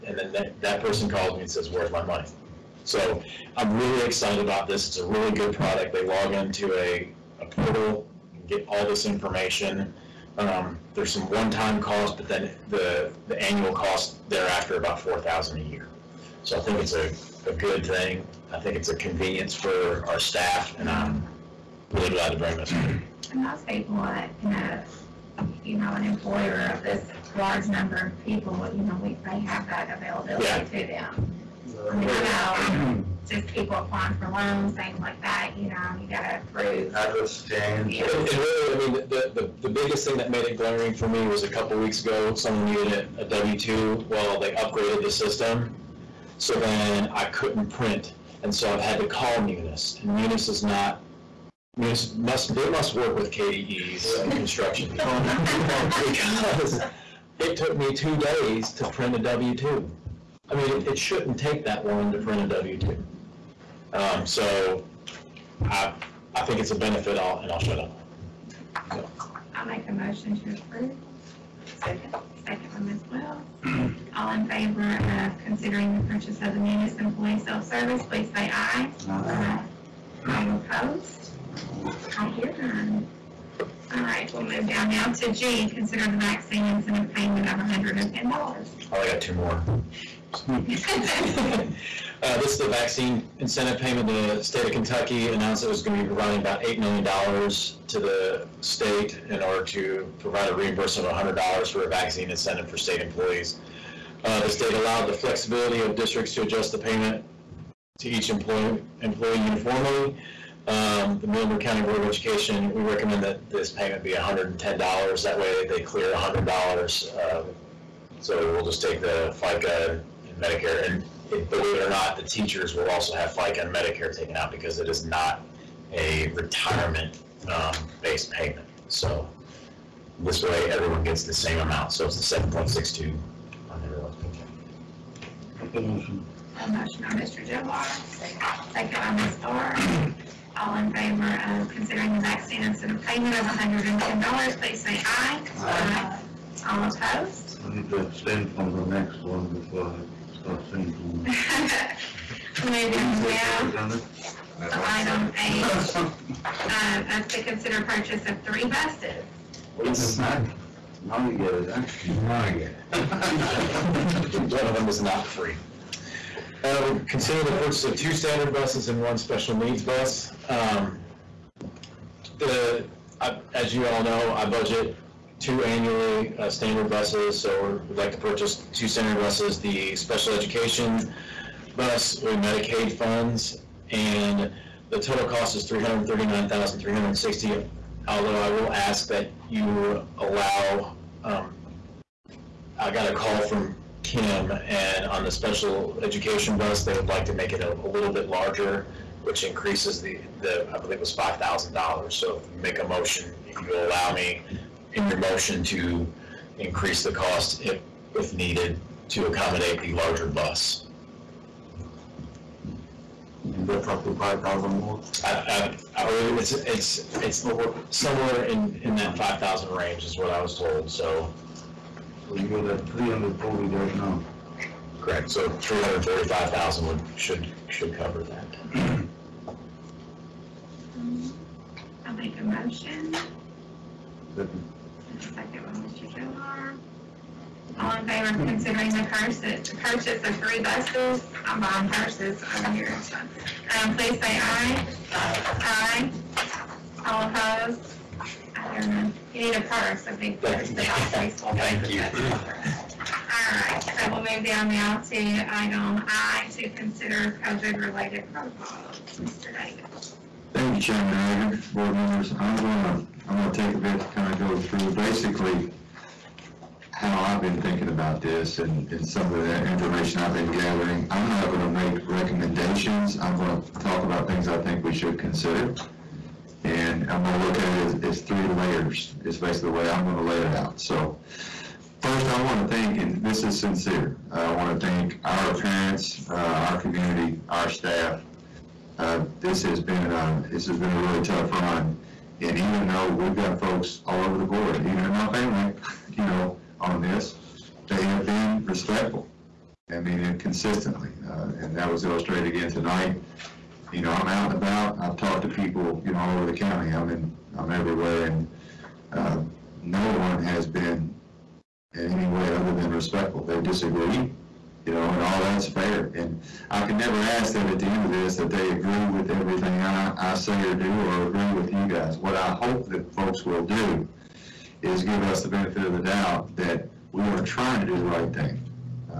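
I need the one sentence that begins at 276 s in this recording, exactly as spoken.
And I'm going to look at it as, as three layers, is basically the way I'm going to lay it out.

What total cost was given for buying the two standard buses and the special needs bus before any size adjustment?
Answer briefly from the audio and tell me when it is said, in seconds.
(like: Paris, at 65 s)
339,360, at 185 s.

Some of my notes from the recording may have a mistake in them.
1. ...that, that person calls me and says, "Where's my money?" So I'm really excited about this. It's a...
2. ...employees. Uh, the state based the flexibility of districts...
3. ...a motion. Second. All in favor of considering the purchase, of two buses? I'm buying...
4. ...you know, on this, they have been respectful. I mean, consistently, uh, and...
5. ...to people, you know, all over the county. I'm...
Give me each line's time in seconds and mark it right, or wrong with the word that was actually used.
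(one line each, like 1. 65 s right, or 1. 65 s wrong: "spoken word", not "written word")
1. 0 s right
2. 103 s wrong: "allowed", not "based"
3. 232 s wrong: "three", not "two"
4. 296 s right
5. 305 s right.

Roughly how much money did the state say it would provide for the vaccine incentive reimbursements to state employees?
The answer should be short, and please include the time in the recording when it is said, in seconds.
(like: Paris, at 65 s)
$8 million, at 96 s.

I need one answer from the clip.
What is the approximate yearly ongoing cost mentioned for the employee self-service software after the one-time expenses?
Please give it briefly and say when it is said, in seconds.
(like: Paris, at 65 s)
4,000, at 14 s.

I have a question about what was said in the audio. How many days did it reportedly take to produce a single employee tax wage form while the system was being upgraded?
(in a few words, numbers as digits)
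2 days.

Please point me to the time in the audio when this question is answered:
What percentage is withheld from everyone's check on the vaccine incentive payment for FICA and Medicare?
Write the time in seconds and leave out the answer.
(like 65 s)
132 s.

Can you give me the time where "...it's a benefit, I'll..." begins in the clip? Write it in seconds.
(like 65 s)
66 s.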